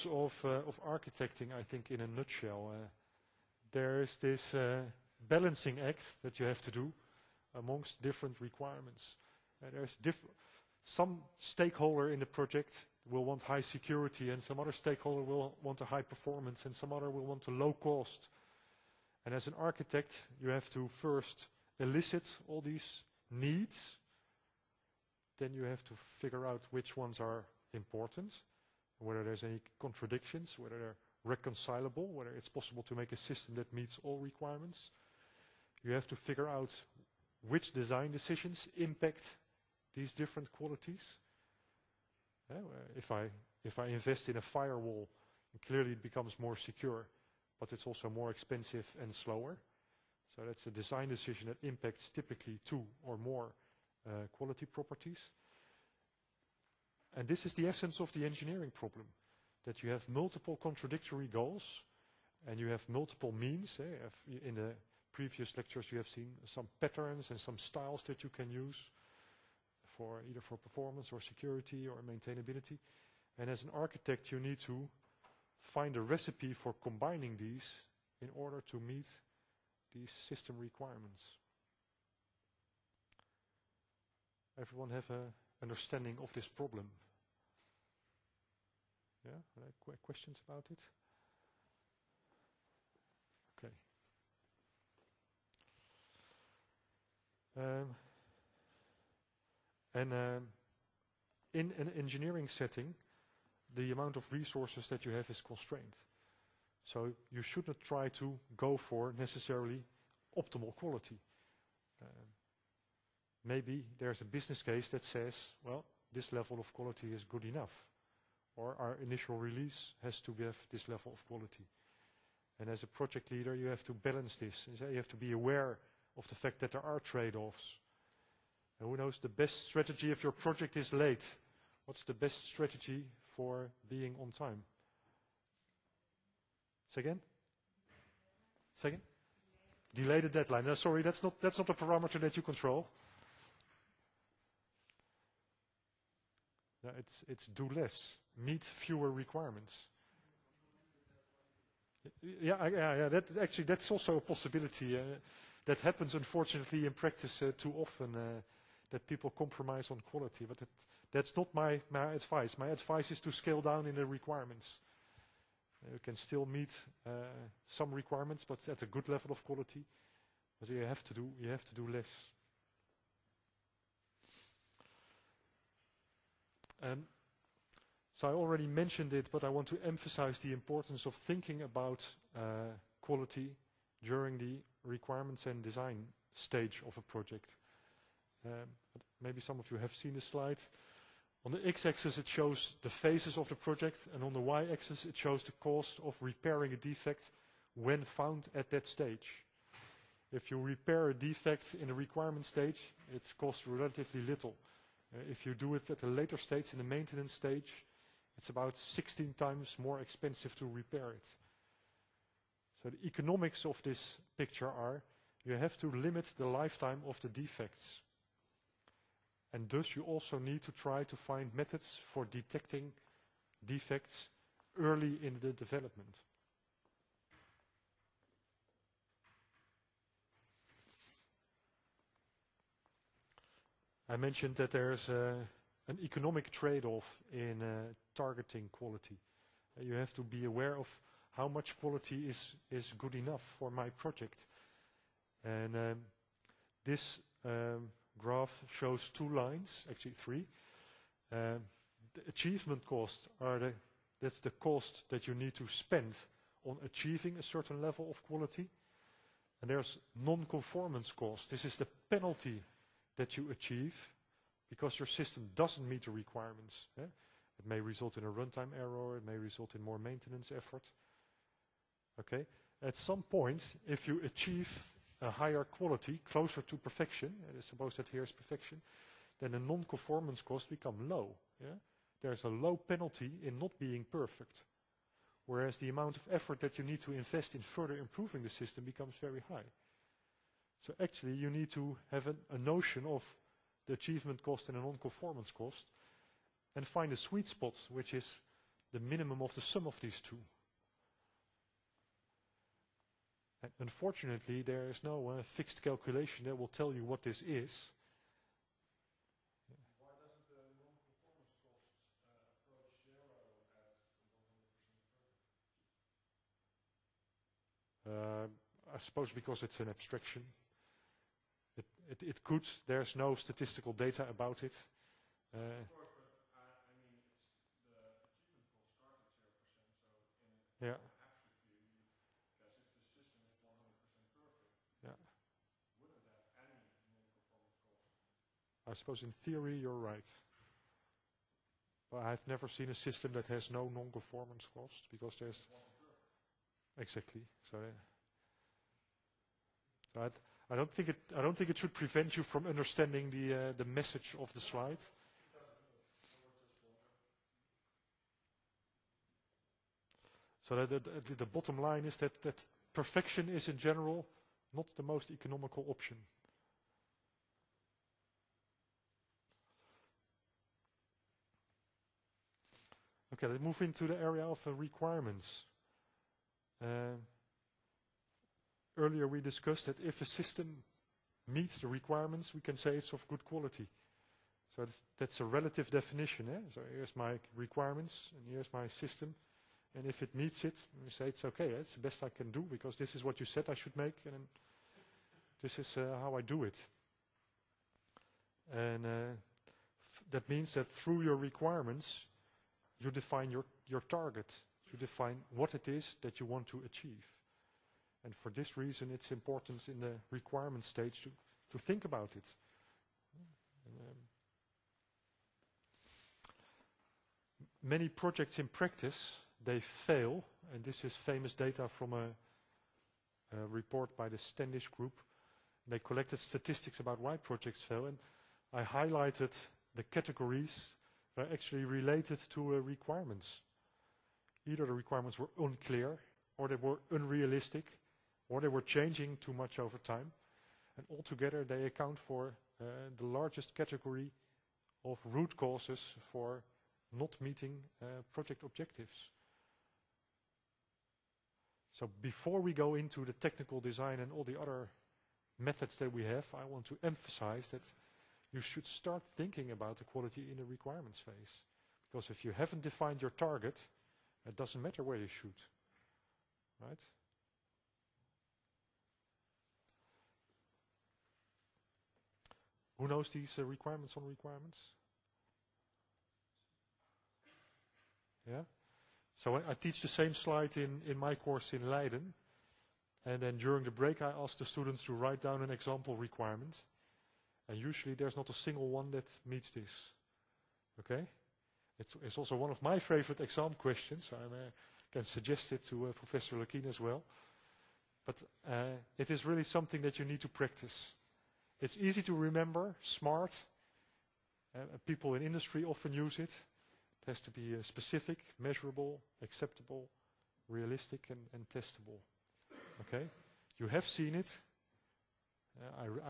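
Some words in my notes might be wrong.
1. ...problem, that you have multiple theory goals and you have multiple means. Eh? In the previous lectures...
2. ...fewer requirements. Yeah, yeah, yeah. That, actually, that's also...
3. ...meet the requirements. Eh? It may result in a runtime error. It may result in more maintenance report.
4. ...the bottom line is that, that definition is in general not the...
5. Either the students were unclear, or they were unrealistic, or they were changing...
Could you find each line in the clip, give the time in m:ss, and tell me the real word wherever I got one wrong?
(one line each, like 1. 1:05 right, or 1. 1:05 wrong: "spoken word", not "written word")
1. 0:58 wrong: "contradictory", not "theory"
2. 2:28 right
3. 4:25 wrong: "effort", not "report"
4. 6:01 wrong: "perfection", not "definition"
5. 7:14 wrong: "requirements", not "students".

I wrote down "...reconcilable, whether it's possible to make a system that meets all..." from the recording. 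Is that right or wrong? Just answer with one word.
right.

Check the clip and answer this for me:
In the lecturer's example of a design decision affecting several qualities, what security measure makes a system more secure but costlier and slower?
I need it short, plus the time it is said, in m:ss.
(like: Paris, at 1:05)
A firewall, at 0:44.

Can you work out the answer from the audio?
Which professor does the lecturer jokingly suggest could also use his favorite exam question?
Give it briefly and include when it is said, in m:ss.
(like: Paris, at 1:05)
Professor Lukkien, at 8:16.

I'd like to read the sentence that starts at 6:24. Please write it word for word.
So that's, that's a relative definition.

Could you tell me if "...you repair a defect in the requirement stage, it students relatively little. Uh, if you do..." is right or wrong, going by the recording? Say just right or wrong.
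wrong.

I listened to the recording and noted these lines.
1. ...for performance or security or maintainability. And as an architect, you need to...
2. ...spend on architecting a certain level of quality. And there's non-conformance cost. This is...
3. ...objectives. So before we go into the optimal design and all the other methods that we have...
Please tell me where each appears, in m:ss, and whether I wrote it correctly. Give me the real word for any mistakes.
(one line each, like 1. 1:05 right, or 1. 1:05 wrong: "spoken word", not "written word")
1. 1:10 right
2. 4:15 wrong: "achieving", not "architecting"
3. 7:28 wrong: "technical", not "optimal".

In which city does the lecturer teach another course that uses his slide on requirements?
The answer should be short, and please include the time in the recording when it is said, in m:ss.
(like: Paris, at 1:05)
Leiden, at 8:01.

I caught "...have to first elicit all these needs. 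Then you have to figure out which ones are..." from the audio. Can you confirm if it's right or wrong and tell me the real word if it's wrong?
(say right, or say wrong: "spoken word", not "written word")
right.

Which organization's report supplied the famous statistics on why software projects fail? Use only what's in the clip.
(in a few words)
The Standish Group.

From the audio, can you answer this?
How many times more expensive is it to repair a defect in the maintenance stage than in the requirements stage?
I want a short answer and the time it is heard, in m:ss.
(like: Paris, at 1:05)
16, at 3:28.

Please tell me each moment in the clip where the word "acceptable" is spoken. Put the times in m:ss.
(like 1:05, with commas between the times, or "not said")
8:29.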